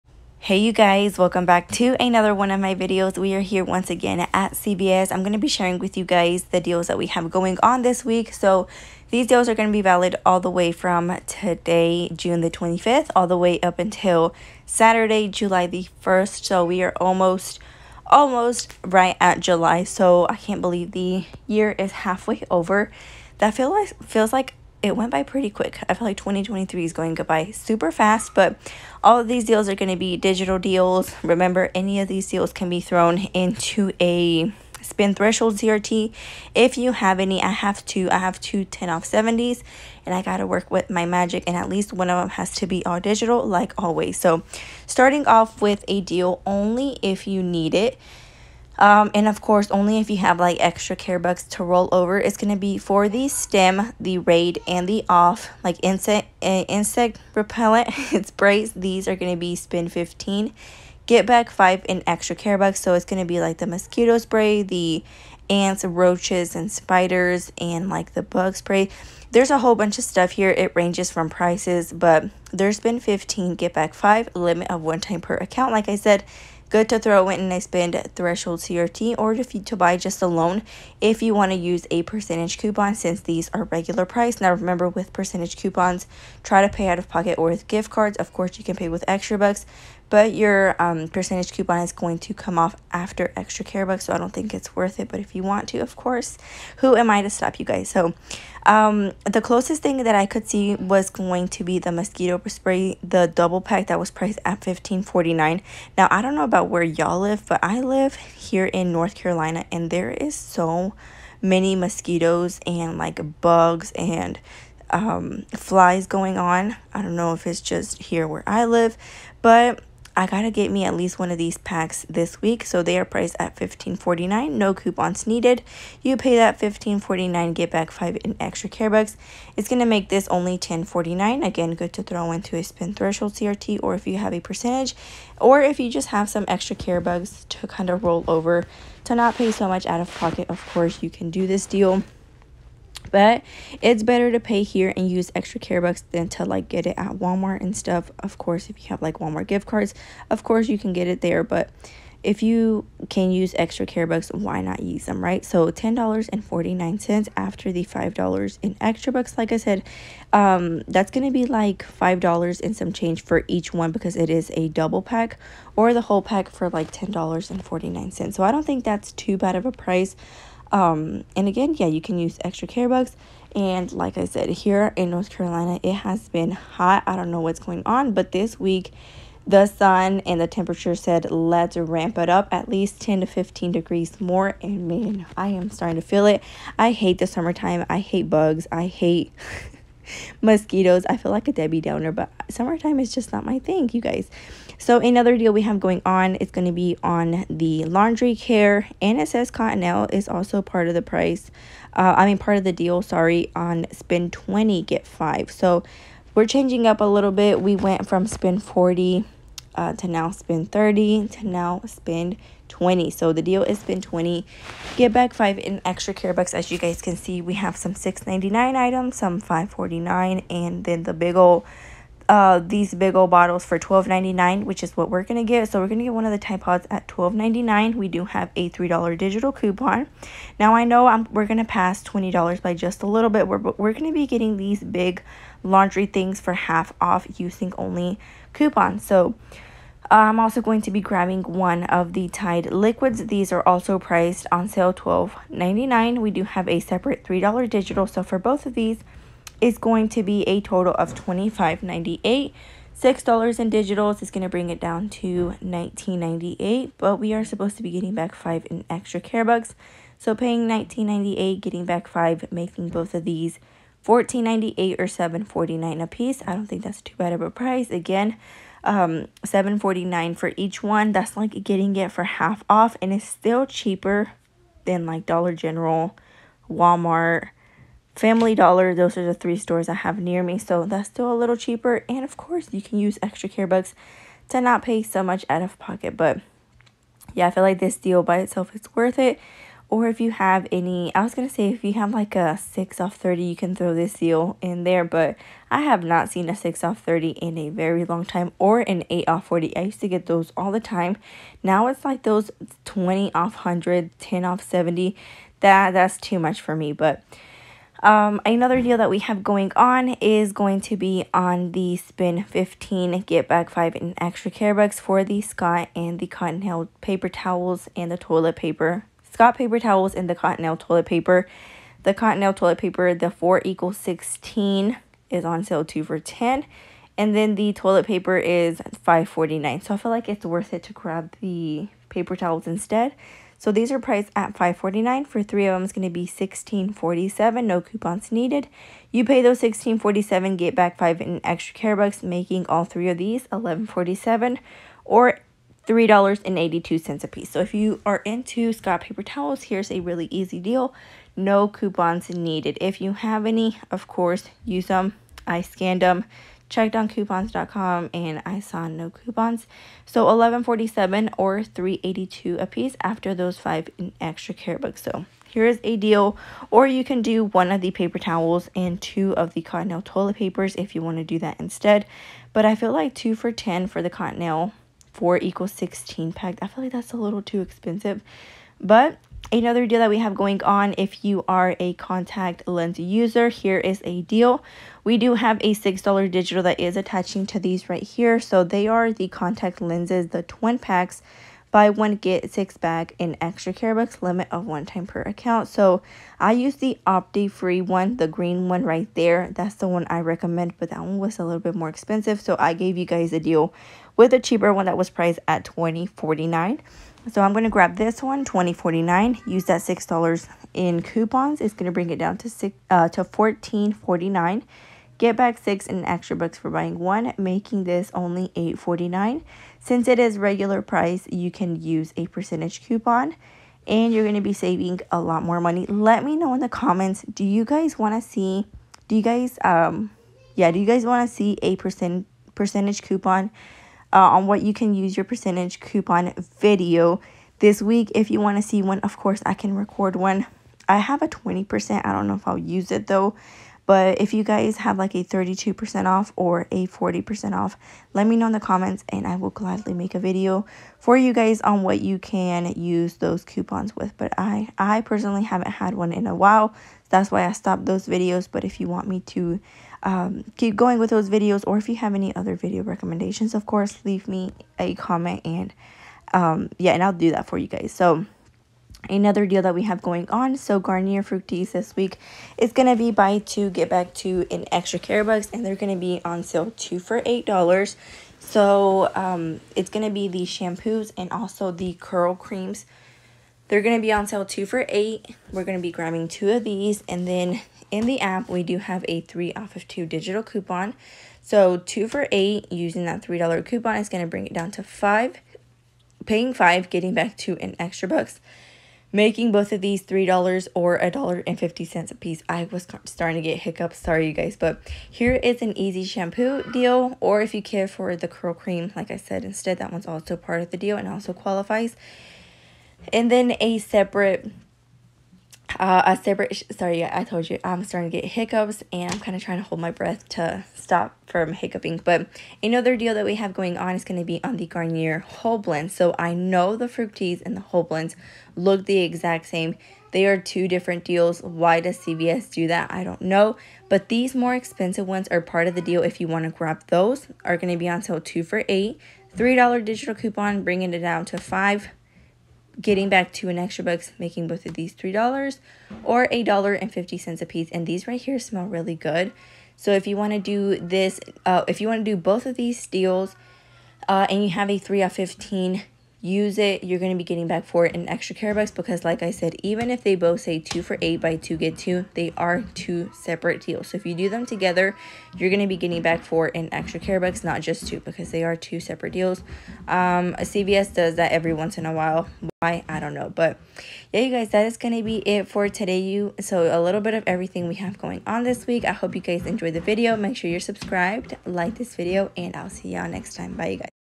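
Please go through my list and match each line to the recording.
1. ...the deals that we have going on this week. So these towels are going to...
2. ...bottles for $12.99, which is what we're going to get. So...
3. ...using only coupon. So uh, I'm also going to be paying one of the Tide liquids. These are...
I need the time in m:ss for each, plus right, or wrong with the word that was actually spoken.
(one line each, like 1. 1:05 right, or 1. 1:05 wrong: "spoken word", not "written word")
1. 0:06 wrong: "deals", not "towels"
2. 3:43 right
3. 3:57 wrong: "grabbing", not "paying".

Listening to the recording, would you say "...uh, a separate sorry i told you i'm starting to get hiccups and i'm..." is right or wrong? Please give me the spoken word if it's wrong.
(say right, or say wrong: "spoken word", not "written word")
right.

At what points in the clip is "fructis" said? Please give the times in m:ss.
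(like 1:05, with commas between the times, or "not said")
7:51, 8:46.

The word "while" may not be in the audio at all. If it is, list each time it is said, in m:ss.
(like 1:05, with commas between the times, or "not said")
7:36, 9:31.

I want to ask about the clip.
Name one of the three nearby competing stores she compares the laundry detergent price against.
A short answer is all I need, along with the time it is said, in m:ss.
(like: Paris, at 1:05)
Dollar General, at 4:35.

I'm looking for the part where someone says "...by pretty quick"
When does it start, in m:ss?
0:25.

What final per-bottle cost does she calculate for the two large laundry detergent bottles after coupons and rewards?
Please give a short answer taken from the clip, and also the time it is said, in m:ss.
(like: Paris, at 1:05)
$7.49, at 4:25.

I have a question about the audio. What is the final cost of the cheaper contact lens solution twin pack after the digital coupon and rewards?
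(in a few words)
$8.49.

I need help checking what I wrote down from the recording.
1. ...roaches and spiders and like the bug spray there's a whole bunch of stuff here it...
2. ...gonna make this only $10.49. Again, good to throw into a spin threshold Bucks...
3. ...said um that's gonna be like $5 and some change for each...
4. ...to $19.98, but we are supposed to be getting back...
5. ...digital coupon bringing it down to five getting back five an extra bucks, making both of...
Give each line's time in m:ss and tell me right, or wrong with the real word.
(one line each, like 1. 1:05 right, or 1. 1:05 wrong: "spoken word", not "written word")
1. 1:05 right
2. 2:09 wrong: "CRT", not "Bucks"
3. 2:39 right
4. 4:15 right
5. 8:59 wrong: "two", not "five".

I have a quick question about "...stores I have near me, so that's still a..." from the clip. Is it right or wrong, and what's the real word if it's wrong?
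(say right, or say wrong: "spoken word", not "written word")
right.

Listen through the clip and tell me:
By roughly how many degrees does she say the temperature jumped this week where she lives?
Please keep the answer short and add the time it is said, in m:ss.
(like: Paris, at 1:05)
10 to 15, at 3:03.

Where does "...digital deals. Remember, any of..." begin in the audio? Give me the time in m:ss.
0:30.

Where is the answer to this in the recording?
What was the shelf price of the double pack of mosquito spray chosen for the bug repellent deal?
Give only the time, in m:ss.
1:44.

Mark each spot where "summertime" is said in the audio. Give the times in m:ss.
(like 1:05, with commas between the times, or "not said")
3:07, 3:12.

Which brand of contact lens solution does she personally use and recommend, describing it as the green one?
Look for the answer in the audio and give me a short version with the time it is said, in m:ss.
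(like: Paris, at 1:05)
Opti free, at 6:37.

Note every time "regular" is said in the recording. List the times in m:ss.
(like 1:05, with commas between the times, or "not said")
1:23, 7:00.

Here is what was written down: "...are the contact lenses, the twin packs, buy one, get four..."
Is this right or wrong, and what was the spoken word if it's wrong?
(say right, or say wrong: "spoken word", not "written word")
wrong: "six", not "four".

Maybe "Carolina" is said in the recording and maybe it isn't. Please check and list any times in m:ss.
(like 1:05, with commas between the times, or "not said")
1:49, 2:55.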